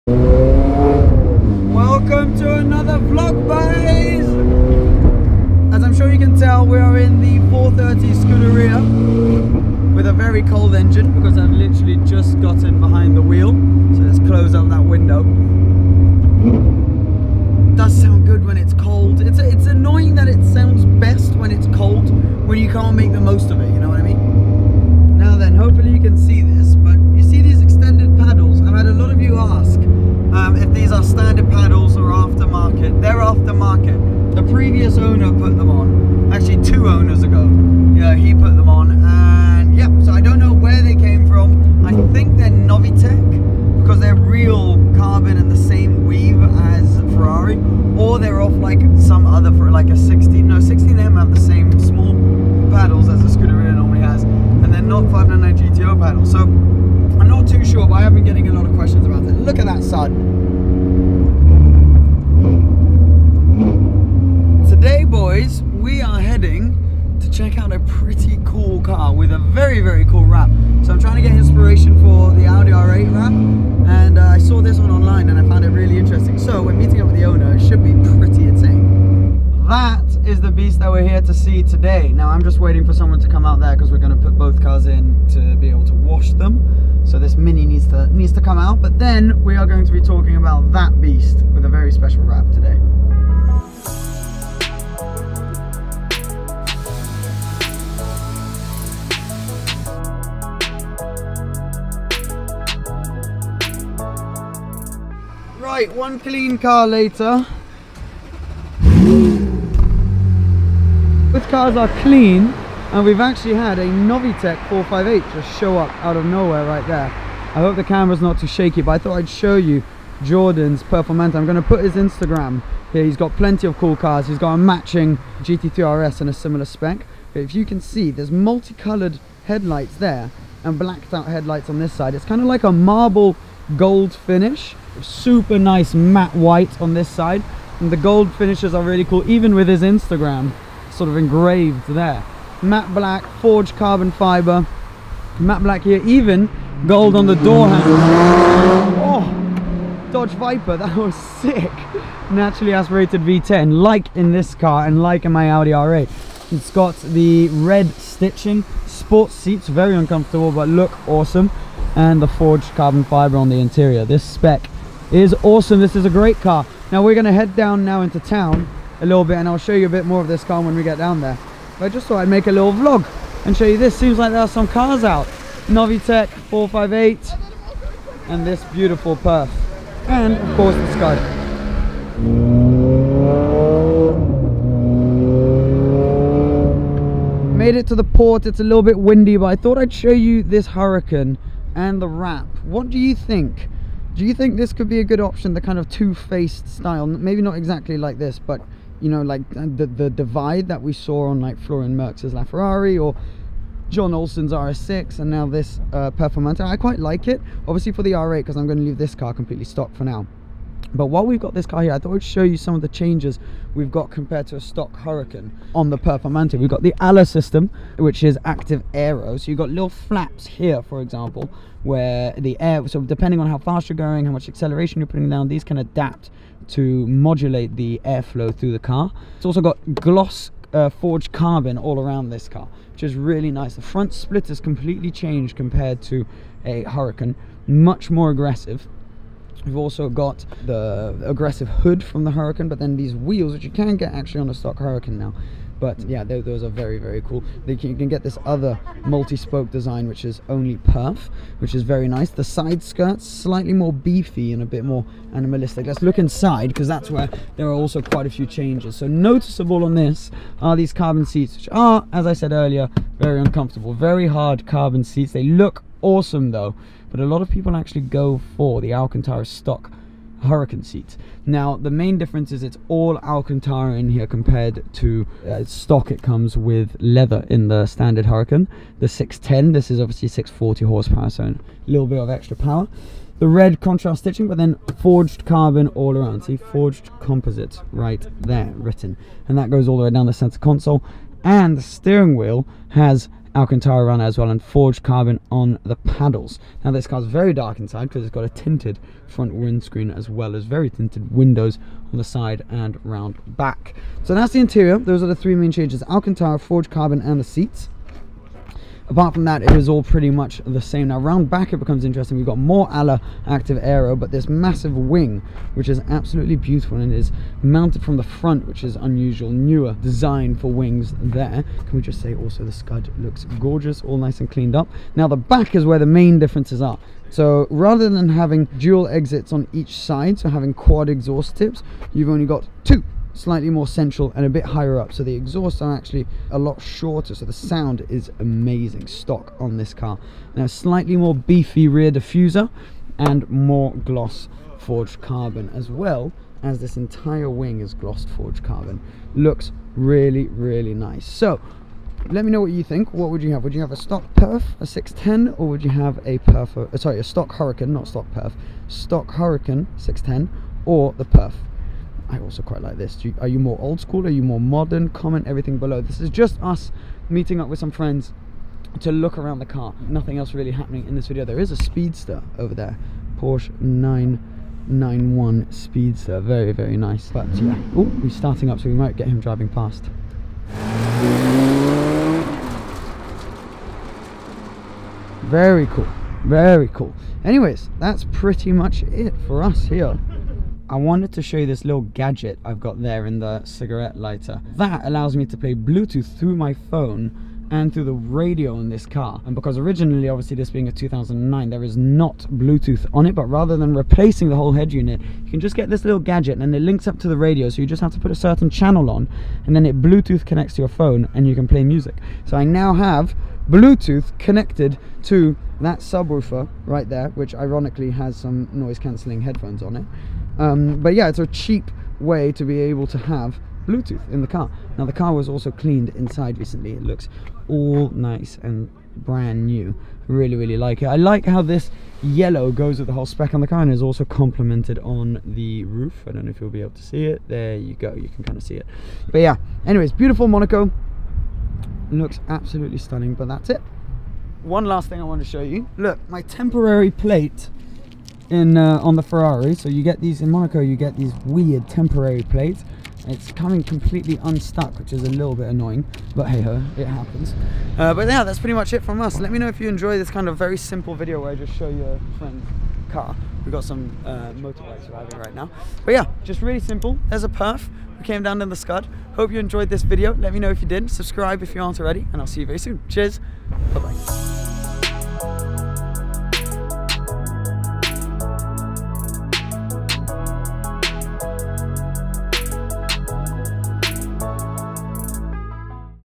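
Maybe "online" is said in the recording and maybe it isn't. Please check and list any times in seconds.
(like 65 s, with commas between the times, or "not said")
74 s.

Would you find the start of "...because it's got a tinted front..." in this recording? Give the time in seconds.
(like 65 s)
298 s.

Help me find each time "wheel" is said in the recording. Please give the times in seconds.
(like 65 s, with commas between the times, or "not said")
13 s, 243 s, 292 s.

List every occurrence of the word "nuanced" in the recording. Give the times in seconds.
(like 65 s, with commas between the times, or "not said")
not said.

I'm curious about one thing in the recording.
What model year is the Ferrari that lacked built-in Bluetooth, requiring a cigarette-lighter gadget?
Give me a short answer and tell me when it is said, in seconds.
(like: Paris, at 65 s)
2009, at 400 s.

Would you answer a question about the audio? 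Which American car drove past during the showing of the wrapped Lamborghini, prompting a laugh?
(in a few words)
Dodge Viper.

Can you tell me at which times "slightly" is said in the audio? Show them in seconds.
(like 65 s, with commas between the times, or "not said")
253 s, 333 s, 340 s.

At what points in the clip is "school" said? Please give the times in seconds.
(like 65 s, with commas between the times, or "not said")
363 s.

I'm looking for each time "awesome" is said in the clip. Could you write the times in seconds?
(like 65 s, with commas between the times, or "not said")
161 s, 165 s, 266 s.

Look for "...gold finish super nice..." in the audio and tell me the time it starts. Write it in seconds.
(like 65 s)
133 s.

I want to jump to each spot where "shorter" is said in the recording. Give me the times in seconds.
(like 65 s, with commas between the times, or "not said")
336 s.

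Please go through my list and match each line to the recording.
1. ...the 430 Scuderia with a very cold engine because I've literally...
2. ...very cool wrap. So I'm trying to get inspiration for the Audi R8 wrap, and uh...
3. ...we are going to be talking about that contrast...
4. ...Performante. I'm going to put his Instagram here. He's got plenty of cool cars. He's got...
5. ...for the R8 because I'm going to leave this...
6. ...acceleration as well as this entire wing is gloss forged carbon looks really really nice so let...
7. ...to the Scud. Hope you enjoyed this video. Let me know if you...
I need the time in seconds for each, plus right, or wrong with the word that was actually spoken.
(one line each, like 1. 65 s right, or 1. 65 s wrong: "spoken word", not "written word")
1. 7 s right
2. 69 s right
3. 89 s wrong: "beast", not "contrast"
4. 120 s right
5. 207 s right
6. 345 s wrong: "carbon", not "acceleration"
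7. 468 s right.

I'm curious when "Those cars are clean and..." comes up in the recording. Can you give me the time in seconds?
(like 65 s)
111 s.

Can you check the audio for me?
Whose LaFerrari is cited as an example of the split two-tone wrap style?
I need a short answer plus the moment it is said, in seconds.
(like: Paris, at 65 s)
Florian Merckx, at 201 s.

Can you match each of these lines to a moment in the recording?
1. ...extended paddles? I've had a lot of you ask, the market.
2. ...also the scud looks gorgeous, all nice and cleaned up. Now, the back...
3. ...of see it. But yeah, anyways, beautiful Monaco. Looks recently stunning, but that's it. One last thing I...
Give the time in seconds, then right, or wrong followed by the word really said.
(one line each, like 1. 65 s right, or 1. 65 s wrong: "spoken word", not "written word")
1. 27 s right
2. 322 s right
3. 438 s wrong: "absolutely", not "recently".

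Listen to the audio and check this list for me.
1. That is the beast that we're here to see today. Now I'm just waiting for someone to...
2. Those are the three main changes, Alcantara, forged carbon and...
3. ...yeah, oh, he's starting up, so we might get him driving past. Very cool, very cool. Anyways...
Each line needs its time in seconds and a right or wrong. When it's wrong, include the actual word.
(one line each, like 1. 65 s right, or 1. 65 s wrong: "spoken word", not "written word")
1. 79 s right
2. 304 s right
3. 377 s right.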